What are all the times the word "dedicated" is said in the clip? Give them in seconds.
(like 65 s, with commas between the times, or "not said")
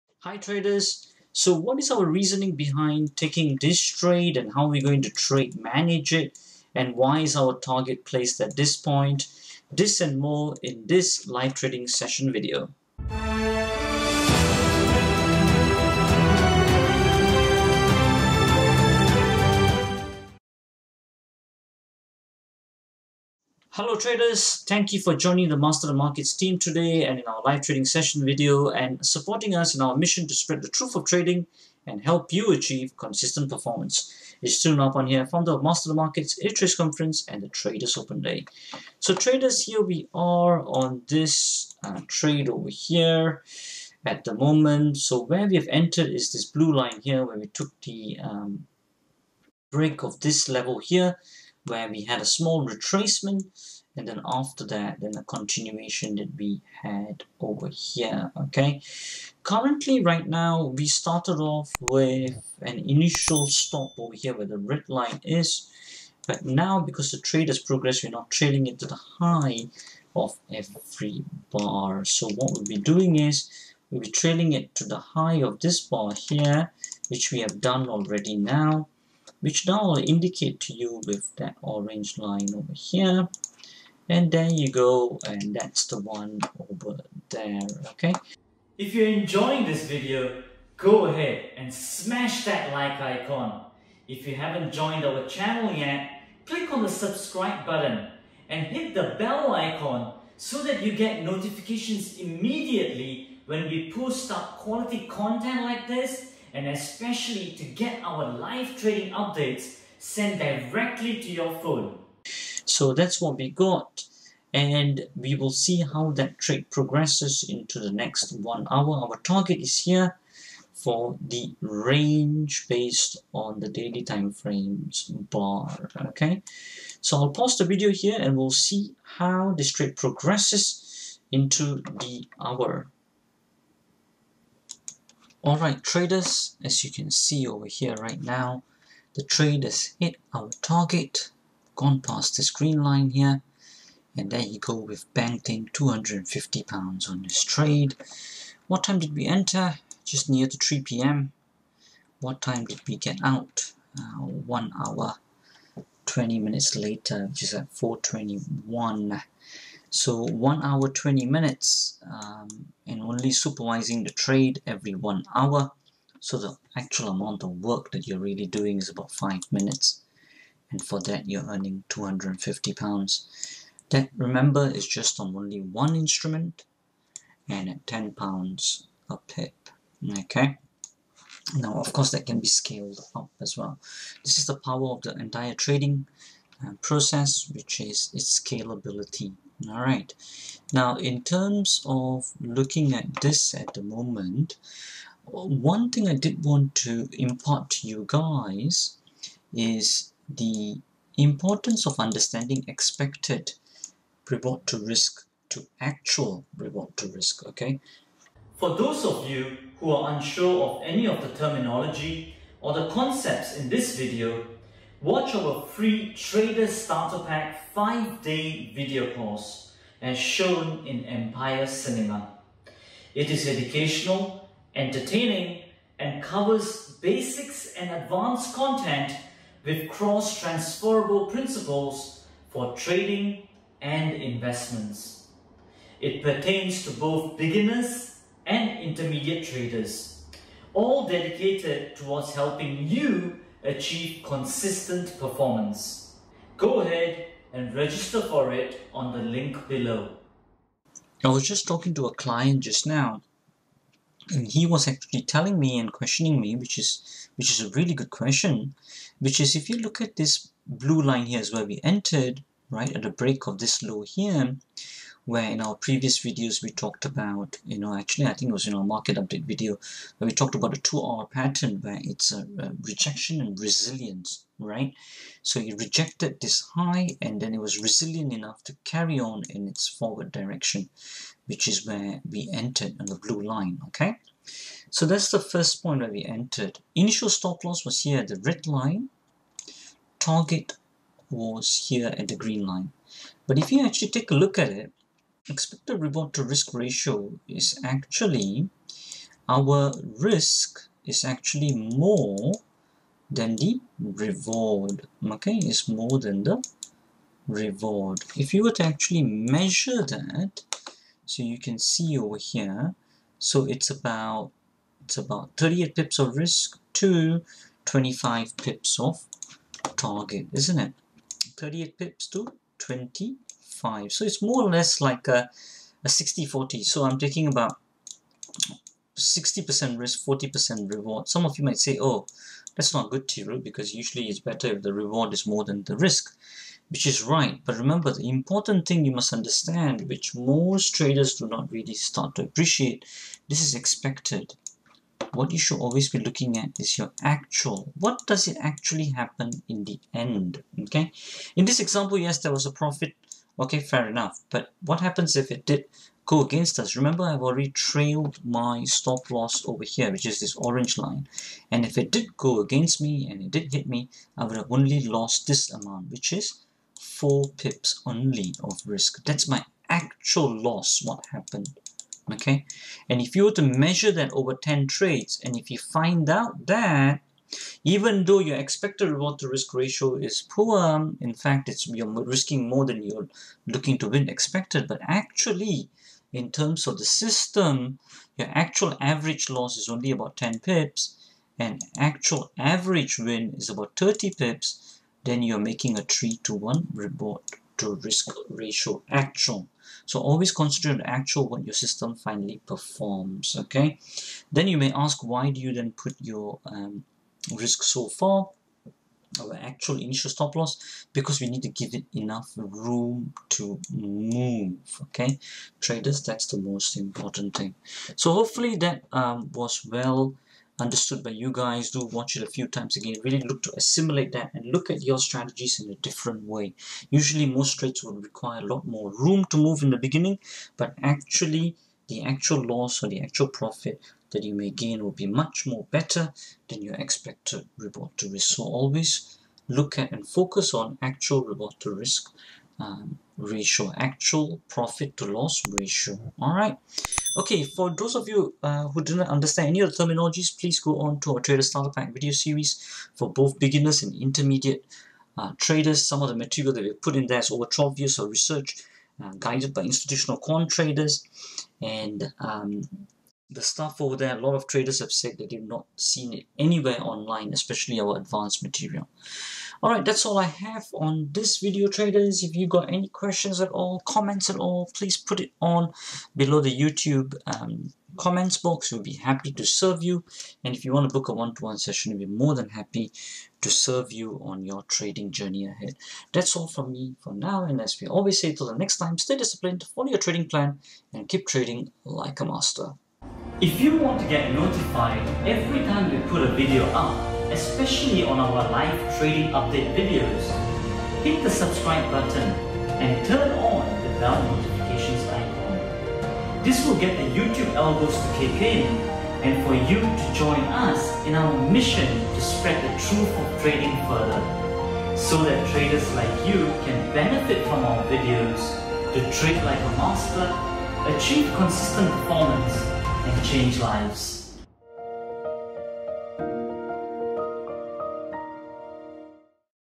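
241 s.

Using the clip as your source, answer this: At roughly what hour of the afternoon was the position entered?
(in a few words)
3 p.m.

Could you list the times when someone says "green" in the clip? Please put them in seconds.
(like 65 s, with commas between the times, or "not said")
142 s, 292 s.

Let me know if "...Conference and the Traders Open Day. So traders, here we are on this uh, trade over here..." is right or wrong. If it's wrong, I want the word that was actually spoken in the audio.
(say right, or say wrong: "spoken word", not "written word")
right.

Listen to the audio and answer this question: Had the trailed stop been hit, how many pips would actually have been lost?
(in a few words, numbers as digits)
4 pips.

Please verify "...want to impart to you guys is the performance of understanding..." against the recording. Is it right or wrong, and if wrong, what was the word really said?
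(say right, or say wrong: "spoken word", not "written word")
wrong: "importance", not "performance".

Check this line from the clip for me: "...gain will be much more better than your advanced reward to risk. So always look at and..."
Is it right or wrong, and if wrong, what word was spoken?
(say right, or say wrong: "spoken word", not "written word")
wrong: "expected", not "advanced".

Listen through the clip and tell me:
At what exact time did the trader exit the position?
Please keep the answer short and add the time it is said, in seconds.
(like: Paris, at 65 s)
4.21, at 157 s.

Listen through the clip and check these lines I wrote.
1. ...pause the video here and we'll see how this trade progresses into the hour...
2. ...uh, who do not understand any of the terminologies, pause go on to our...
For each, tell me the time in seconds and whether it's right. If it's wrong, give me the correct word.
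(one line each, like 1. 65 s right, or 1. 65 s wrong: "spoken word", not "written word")
1. 127 s right
2. 448 s wrong: "please", not "pause".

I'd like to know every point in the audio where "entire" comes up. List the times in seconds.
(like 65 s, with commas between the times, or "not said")
185 s.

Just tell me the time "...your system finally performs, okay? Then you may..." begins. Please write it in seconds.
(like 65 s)
401 s.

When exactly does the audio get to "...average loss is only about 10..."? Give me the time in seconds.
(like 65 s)
389 s.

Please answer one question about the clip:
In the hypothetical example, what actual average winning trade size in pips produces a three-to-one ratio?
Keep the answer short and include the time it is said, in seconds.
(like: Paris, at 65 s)
30 pips, at 393 s.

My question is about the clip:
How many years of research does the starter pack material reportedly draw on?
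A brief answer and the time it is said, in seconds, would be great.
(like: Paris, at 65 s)
12 years, at 457 s.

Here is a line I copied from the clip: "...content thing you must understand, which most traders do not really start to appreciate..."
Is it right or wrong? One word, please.
wrong.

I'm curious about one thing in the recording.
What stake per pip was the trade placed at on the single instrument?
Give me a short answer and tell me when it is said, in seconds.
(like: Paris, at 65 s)
10 pounds, at 177 s.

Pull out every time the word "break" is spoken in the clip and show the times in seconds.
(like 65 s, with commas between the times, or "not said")
49 s, 263 s.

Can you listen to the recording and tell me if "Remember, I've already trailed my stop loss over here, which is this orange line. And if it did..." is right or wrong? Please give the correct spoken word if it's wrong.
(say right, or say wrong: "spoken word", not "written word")
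right.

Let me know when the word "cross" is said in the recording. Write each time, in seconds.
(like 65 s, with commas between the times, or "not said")
229 s.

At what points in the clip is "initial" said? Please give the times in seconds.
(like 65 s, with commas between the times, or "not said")
62 s, 286 s, 410 s.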